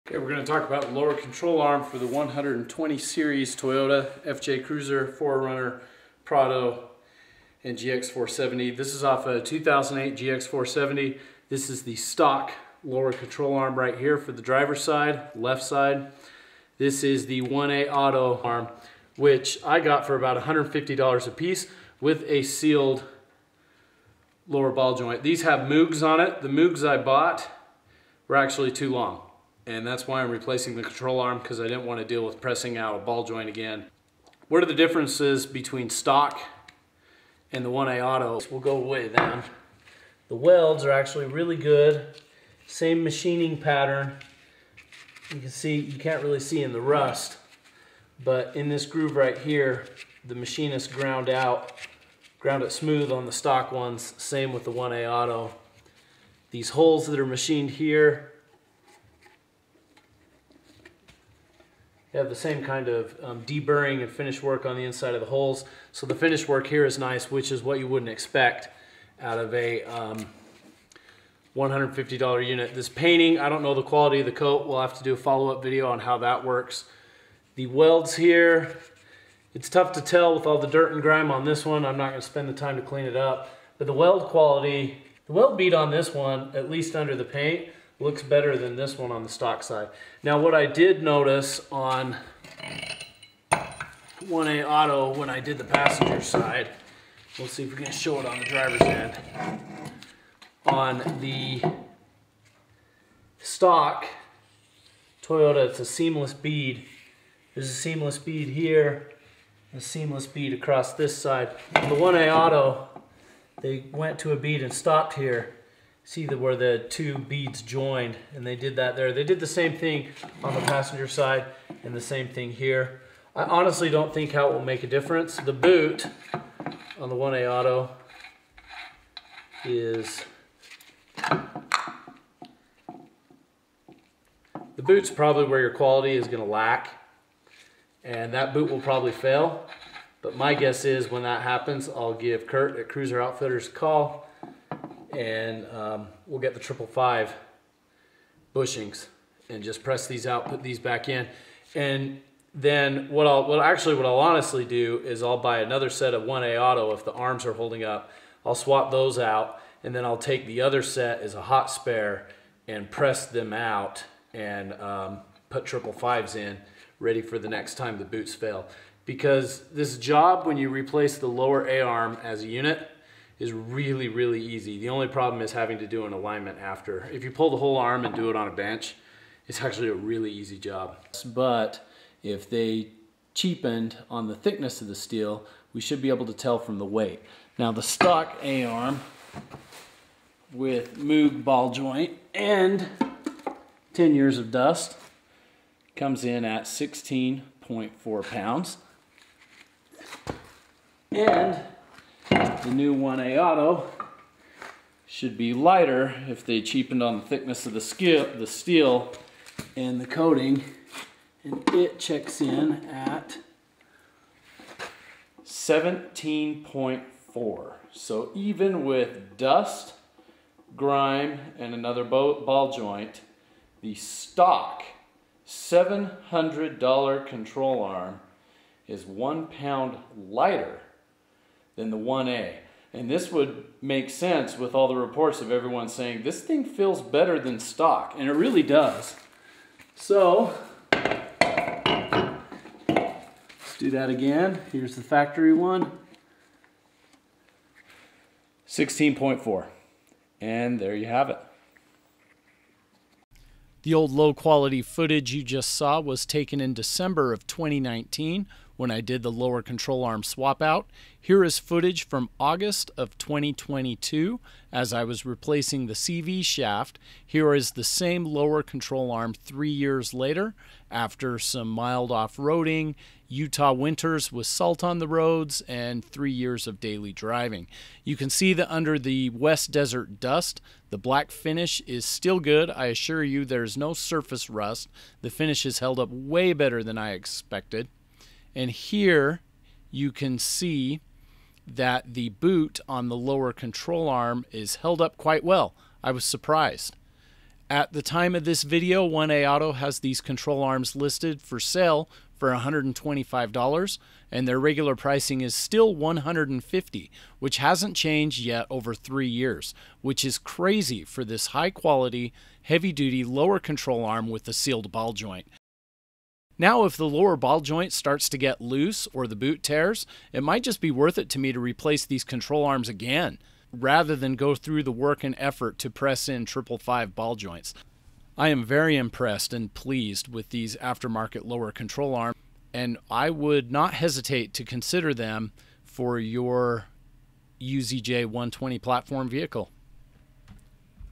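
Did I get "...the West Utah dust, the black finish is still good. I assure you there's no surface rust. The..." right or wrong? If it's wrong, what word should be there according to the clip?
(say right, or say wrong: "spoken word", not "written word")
wrong: "Desert", not "Utah".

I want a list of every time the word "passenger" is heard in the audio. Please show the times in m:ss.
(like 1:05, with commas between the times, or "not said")
1:35, 2:00.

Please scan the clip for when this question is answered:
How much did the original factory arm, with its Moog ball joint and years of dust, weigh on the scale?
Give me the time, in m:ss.
3:16.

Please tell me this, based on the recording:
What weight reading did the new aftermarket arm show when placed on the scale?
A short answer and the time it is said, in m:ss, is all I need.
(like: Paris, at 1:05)
17.4, at 3:35.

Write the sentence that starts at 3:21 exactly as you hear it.
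And the new 1A Auto should be lighter if they cheapened on the thickness of the skip, the steel, and the coating.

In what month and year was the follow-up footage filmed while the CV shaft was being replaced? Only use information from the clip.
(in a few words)
August 2022.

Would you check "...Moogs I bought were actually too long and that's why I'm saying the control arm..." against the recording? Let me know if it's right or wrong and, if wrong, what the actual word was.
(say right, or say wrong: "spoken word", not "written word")
wrong: "replacing", not "saying".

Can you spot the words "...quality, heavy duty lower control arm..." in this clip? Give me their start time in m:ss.
5:11.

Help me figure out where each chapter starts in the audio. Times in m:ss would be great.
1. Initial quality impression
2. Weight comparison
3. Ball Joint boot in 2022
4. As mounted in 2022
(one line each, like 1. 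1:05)
1. 0:34
2. 3:00
3. 4:27
4. 4:13.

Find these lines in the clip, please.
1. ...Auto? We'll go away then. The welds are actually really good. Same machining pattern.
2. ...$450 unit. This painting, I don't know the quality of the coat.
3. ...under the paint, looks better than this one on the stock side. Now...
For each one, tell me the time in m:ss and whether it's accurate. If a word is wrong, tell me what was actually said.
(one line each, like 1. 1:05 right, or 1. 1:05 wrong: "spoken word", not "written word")
1. 0:38 right
2. 1:11 wrong: "150", not "450"
3. 1:26 right.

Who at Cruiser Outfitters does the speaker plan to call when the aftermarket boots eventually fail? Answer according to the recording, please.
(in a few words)
Kurt.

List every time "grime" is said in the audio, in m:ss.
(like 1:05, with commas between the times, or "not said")
1:21, 3:40.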